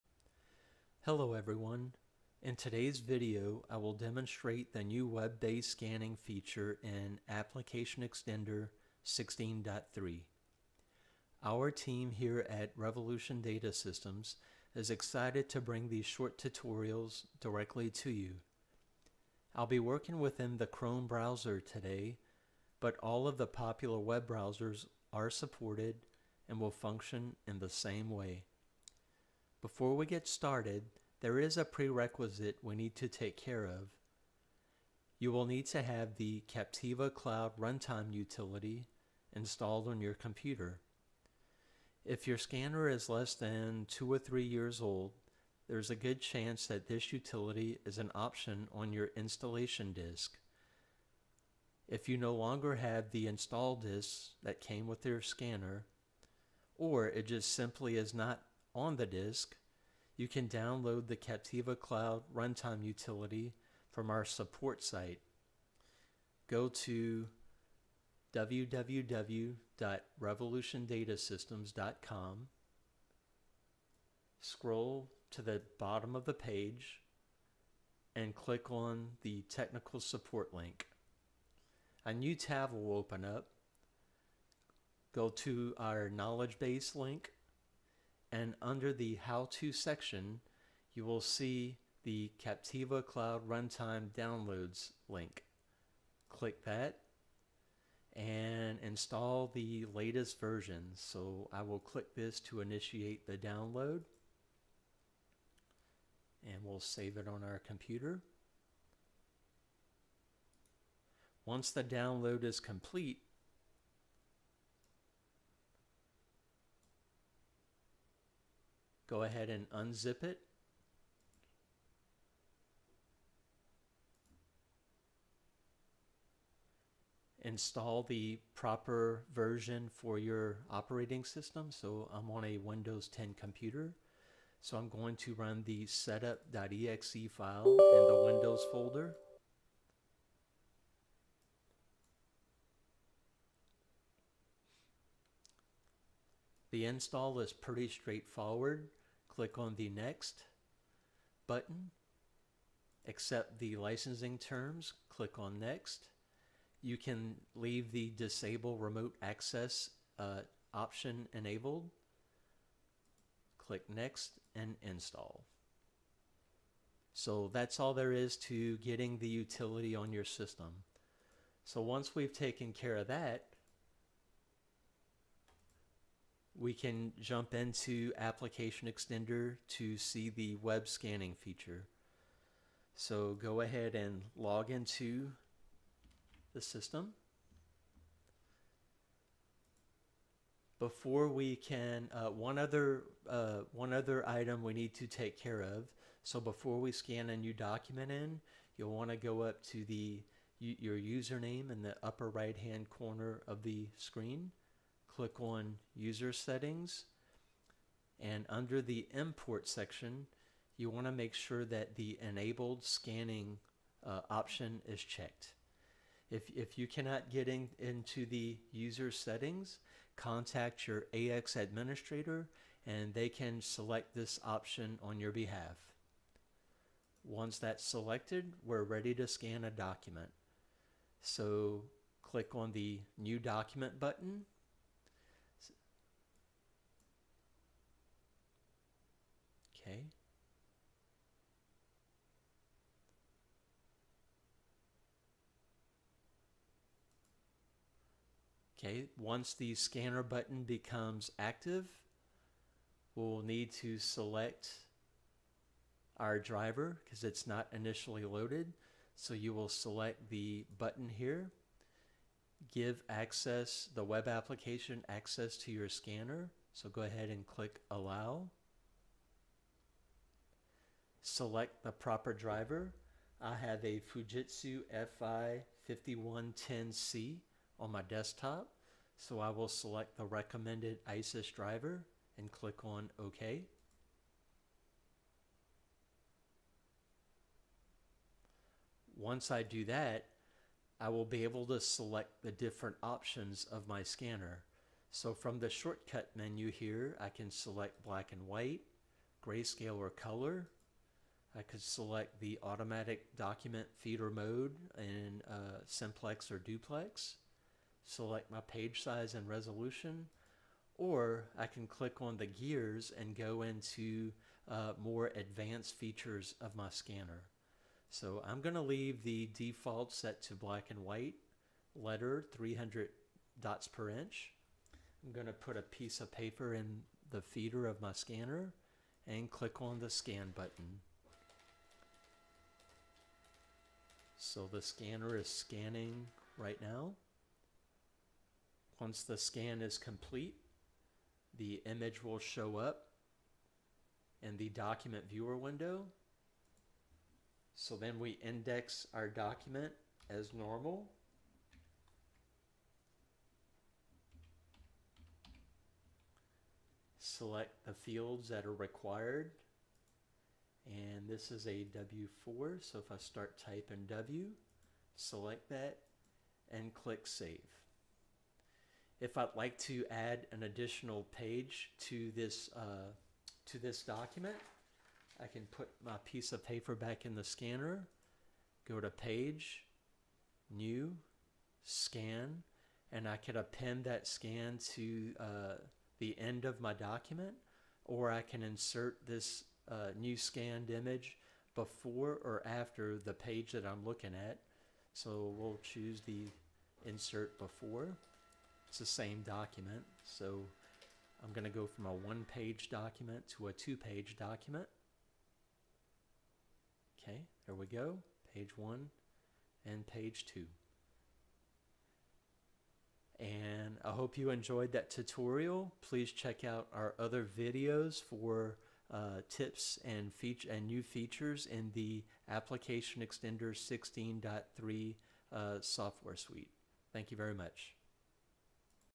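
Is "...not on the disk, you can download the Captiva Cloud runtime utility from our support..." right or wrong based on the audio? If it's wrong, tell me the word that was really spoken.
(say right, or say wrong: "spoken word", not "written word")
right.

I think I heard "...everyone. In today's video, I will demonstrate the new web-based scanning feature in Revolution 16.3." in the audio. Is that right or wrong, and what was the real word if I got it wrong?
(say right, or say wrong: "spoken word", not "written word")
wrong: "ApplicationXtender", not "Revolution".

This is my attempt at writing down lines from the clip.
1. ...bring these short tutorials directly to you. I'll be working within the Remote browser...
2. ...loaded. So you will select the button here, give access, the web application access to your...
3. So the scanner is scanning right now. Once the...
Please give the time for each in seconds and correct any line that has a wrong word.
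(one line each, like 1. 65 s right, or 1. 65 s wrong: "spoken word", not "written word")
1. 15 s wrong: "Chrome", not "Remote"
2. 258 s right
3. 334 s right.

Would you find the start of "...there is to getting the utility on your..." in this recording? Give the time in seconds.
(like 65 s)
167 s.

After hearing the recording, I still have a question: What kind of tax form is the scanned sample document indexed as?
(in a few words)
W4.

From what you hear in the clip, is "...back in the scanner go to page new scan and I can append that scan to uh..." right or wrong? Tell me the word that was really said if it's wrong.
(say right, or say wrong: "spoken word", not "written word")
right.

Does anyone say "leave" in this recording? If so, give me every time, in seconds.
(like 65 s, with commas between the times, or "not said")
157 s, 318 s.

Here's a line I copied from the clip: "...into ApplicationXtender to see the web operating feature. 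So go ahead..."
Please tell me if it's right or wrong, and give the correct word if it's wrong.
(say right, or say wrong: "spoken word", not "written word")
wrong: "scanning", not "operating".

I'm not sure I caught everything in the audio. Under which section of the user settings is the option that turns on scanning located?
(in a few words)
Import.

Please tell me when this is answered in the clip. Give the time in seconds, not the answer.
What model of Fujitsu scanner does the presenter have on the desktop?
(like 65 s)
275 s.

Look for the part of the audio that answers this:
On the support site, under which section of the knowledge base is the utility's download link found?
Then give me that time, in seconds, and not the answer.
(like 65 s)
89 s.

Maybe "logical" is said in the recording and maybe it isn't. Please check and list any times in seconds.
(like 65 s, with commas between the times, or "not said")
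not said.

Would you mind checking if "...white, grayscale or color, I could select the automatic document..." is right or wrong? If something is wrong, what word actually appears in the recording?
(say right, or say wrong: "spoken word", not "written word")
right.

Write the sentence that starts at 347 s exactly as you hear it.
So then we index our document as normal.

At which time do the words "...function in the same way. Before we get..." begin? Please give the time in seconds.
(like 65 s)
26 s.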